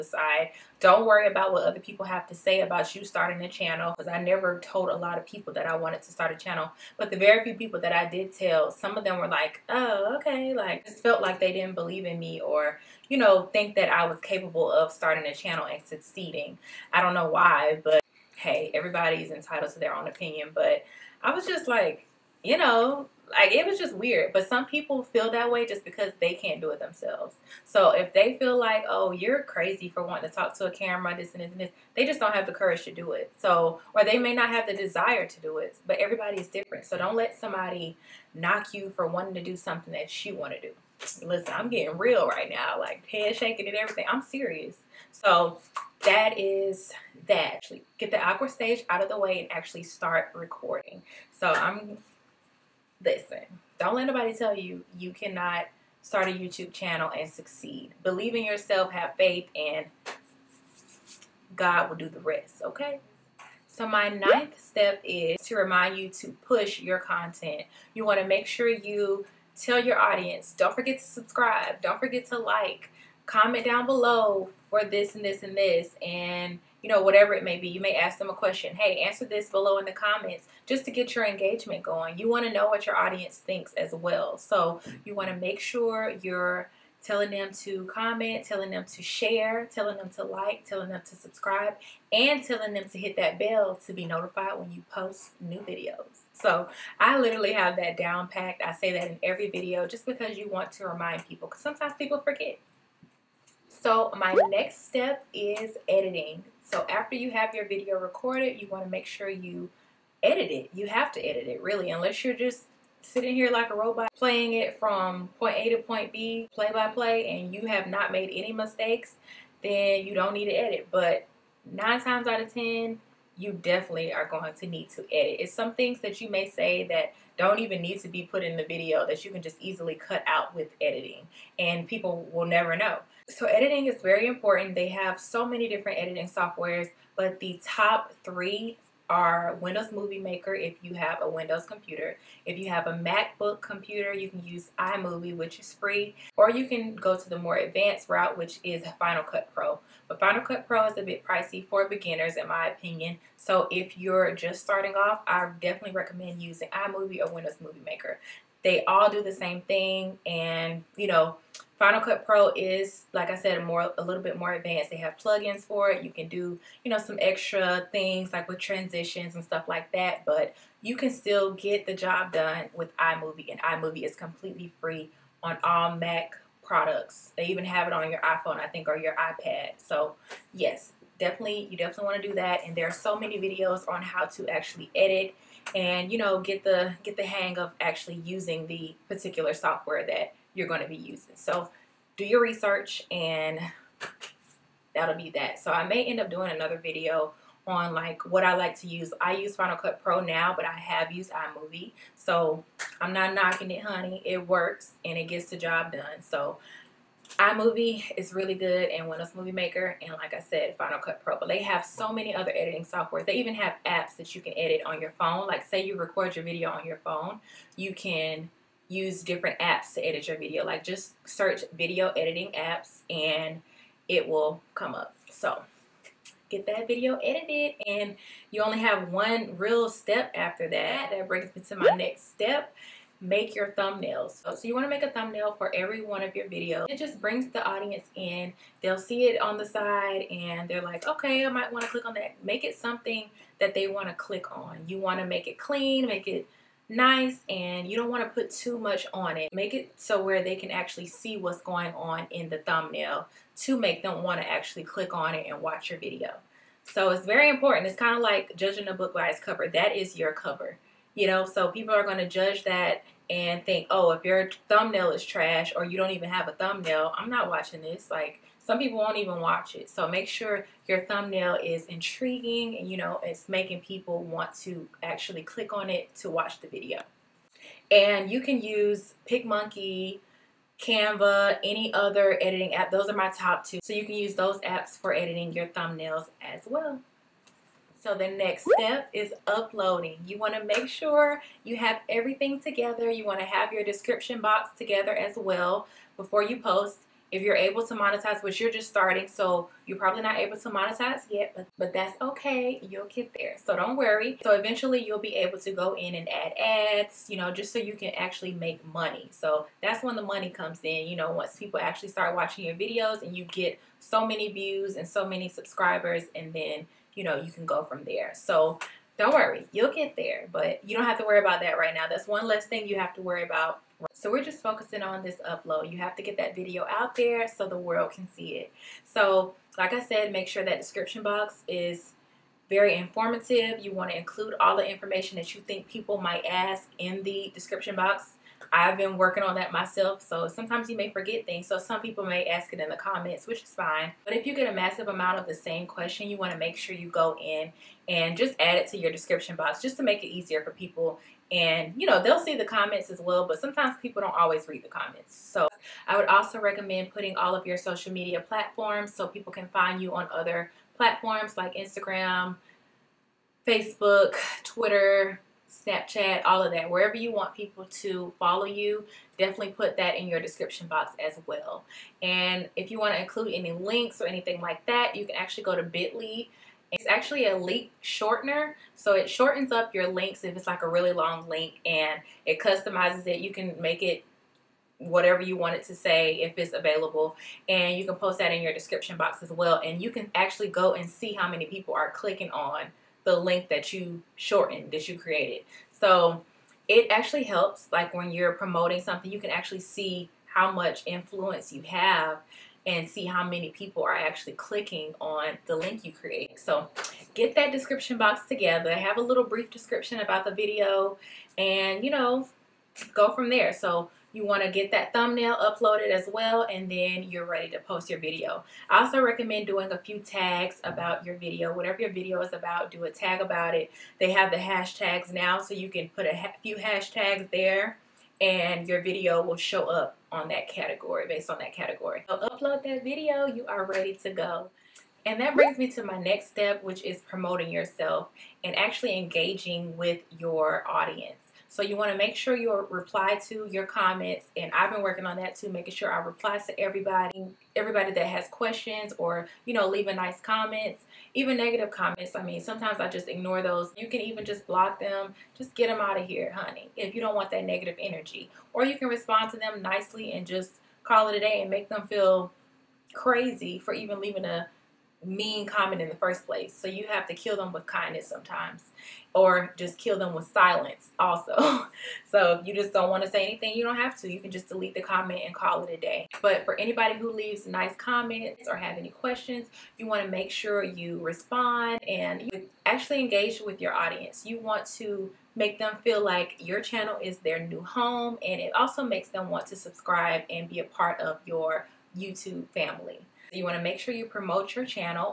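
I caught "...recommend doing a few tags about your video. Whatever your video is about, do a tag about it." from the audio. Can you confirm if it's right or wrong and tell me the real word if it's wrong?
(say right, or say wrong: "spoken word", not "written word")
right.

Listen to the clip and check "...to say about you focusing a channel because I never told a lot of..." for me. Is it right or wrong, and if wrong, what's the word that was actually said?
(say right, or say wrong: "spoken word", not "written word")
wrong: "starting", not "focusing".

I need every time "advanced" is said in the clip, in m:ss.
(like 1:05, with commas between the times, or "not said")
2:27, 2:44.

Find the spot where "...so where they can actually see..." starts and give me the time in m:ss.
4:09.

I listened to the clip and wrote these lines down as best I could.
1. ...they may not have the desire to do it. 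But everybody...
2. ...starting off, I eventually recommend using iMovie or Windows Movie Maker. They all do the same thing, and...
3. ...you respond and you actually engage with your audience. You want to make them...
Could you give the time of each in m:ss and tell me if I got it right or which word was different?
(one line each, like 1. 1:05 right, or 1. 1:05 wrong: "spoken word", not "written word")
1. 0:34 right
2. 2:34 wrong: "definitely", not "eventually"
3. 8:00 right.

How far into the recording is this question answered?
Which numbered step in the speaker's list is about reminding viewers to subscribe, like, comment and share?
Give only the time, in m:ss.
1:04.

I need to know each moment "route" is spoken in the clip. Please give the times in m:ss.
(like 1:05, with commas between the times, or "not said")
2:28.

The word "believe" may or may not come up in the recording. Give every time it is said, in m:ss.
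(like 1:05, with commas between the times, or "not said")
0:11, 0:58.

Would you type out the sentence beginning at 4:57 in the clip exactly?
If you're able to monetize, which you're just starting, so you're probably not able to monetize yet, but, but that's okay.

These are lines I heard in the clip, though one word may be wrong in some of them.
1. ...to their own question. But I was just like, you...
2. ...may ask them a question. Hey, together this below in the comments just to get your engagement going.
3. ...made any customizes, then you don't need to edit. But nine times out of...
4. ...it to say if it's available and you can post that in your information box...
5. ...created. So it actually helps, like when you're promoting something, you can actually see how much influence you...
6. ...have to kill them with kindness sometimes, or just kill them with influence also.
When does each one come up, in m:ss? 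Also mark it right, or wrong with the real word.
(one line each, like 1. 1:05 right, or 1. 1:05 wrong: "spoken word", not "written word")
1. 0:19 wrong: "opinion", not "question"
2. 1:17 wrong: "answer", not "together"
3. 1:58 wrong: "mistakes", not "customizes"
4. 6:25 wrong: "description", not "information"
5. 6:35 right
6. 7:47 wrong: "silence", not "influence".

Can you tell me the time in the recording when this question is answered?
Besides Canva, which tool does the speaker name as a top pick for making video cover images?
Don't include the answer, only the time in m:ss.
4:39.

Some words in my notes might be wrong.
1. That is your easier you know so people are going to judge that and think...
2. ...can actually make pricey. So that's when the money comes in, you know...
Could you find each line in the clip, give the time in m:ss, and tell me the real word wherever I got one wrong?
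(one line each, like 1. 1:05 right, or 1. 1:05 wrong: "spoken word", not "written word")
1. 4:19 wrong: "cover", not "easier"
2. 5:07 wrong: "money", not "pricey".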